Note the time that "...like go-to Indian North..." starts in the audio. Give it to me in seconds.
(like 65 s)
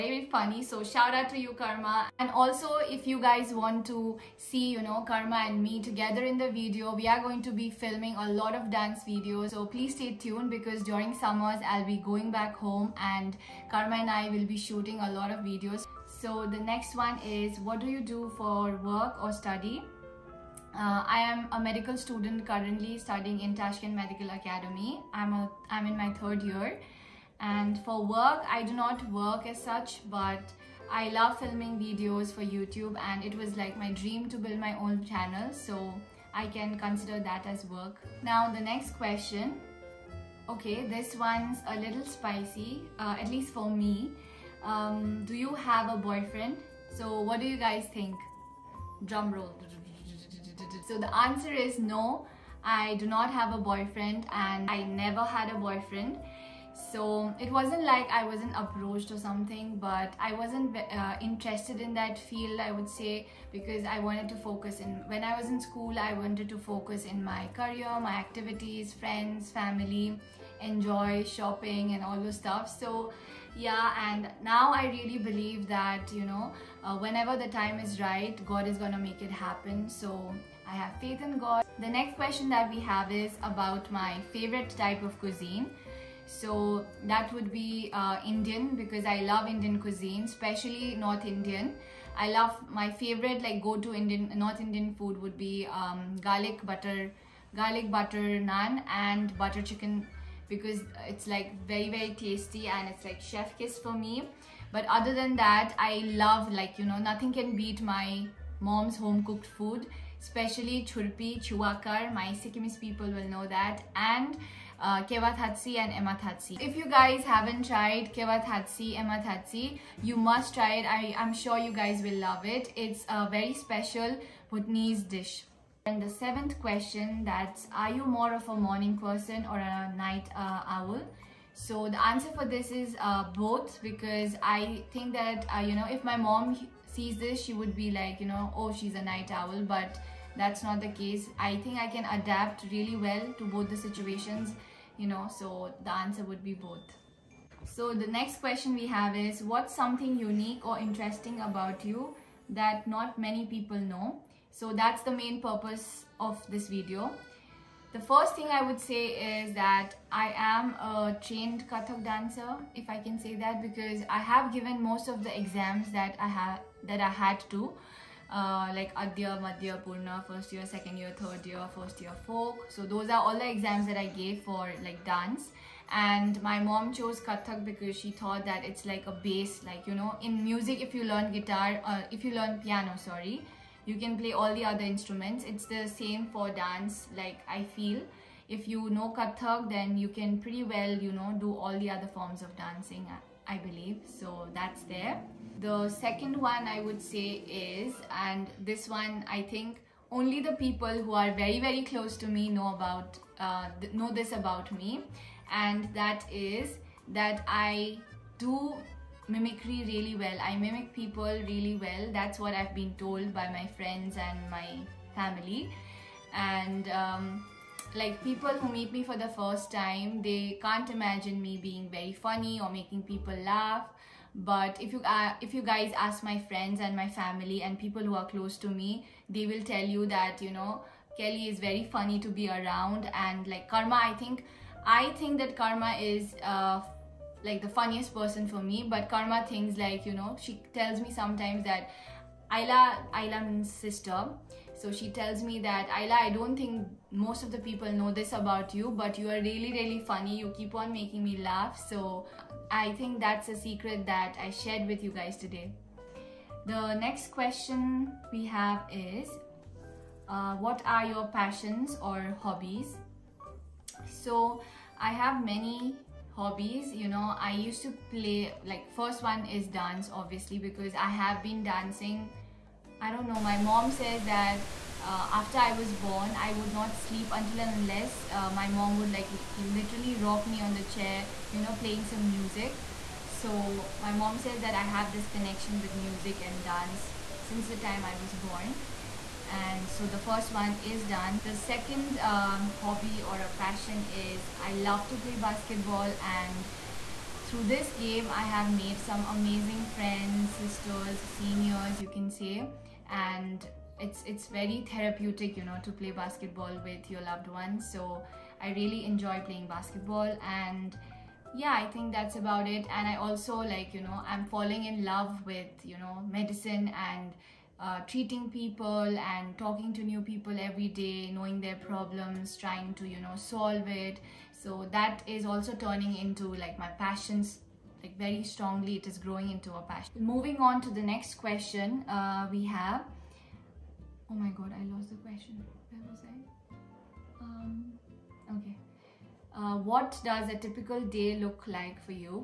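93 s.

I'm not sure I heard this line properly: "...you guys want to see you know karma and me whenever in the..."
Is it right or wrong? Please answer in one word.
wrong.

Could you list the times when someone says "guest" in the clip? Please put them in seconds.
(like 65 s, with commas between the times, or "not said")
not said.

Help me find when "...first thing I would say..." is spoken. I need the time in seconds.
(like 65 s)
157 s.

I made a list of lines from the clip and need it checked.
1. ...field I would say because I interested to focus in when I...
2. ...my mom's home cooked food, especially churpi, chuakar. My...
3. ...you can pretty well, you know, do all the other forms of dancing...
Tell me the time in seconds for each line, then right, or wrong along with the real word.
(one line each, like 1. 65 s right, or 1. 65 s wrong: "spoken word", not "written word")
1. 62 s wrong: "wanted", not "interested"
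2. 107 s right
3. 189 s right.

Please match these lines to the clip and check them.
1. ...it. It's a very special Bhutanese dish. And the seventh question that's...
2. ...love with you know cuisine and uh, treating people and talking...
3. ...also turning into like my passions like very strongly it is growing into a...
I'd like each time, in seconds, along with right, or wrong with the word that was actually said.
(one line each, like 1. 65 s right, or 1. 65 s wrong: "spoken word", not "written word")
1. 122 s right
2. 315 s wrong: "medicine", not "cuisine"
3. 325 s right.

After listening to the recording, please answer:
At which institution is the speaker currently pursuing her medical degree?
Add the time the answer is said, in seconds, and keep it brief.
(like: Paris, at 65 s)
Tashkent Medical Academy, at 23 s.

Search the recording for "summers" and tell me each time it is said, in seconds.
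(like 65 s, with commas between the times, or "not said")
11 s.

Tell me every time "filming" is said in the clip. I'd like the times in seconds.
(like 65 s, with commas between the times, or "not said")
7 s, 31 s.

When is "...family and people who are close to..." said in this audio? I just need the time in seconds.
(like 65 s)
227 s.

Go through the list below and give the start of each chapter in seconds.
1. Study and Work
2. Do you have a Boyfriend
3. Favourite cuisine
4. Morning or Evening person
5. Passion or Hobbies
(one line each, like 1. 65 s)
1. 17 s
2. 38 s
3. 82 s
4. 126 s
5. 257 s.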